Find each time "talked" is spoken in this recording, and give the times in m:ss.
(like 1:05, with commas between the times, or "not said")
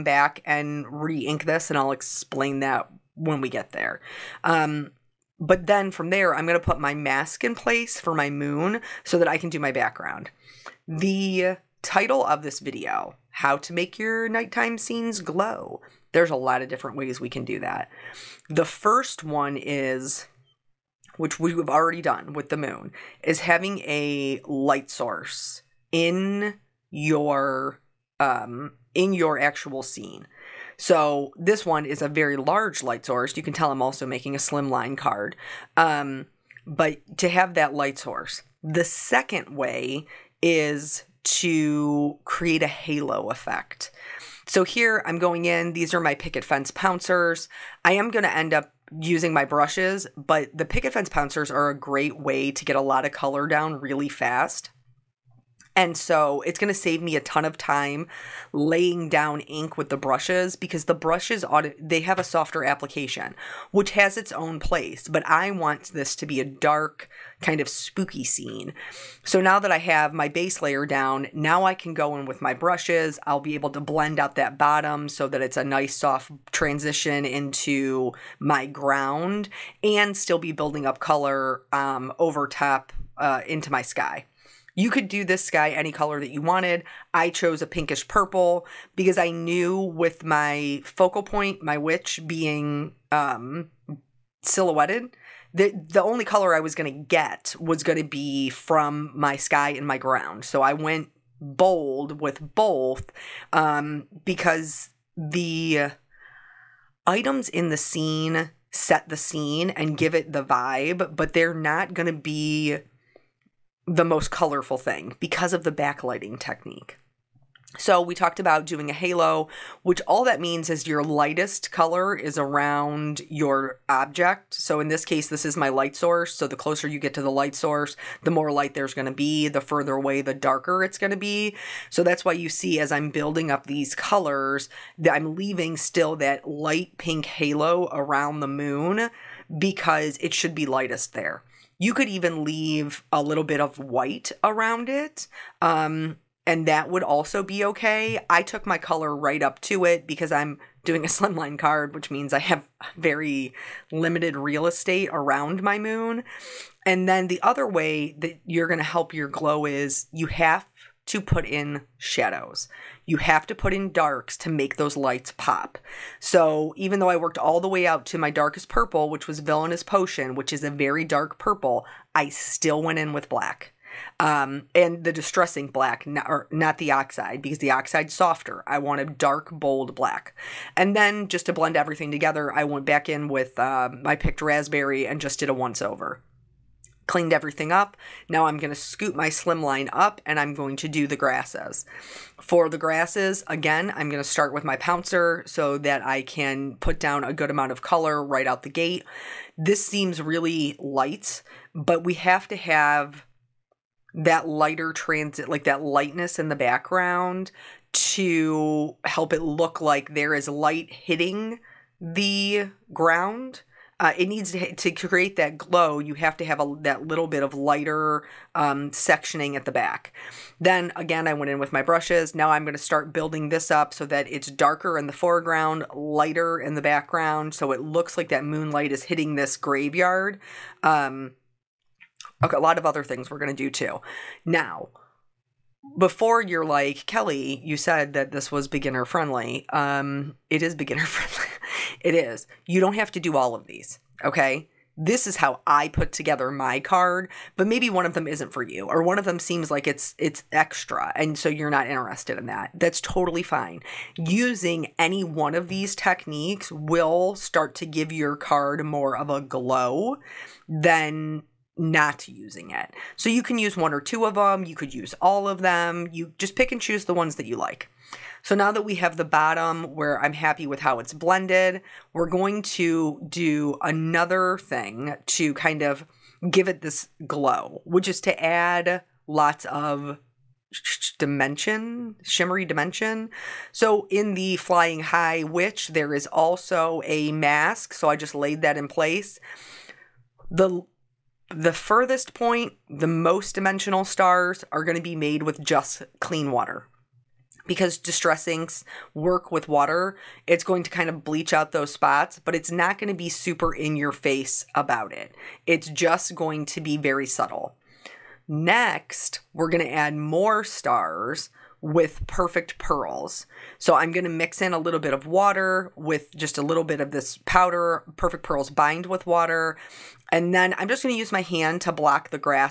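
1:58.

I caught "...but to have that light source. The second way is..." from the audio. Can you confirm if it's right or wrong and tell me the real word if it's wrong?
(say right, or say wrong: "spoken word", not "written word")
right.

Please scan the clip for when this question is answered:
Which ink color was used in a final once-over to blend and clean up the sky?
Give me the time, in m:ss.
3:04.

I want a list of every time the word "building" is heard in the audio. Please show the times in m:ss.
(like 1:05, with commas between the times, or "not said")
1:20, 2:13, 3:43.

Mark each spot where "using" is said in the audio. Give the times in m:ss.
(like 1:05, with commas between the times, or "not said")
0:48, 4:14, 4:22.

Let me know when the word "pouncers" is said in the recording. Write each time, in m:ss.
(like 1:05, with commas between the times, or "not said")
0:46, 0:51, 3:14.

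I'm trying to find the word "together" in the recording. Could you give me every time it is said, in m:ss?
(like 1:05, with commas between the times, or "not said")
3:02, 4:06.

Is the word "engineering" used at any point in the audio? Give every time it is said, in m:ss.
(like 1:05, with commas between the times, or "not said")
not said.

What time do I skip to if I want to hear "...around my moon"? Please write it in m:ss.
2:35.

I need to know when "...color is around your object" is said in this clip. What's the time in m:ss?
2:01.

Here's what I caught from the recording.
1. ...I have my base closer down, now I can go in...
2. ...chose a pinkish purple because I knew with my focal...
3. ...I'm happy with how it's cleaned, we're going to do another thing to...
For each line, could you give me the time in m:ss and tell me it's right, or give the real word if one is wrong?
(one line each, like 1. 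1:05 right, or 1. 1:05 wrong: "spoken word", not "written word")
1. 1:09 wrong: "layer", not "closer"
2. 1:27 right
3. 4:30 wrong: "blended", not "cleaned".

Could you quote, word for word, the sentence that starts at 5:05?
It's just going to be very subtle.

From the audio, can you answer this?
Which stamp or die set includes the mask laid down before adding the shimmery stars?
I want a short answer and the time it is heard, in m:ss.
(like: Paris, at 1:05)
Flying High Witch, at 4:44.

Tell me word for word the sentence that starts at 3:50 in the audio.
Um, okay, a lot of other things we're going to do too.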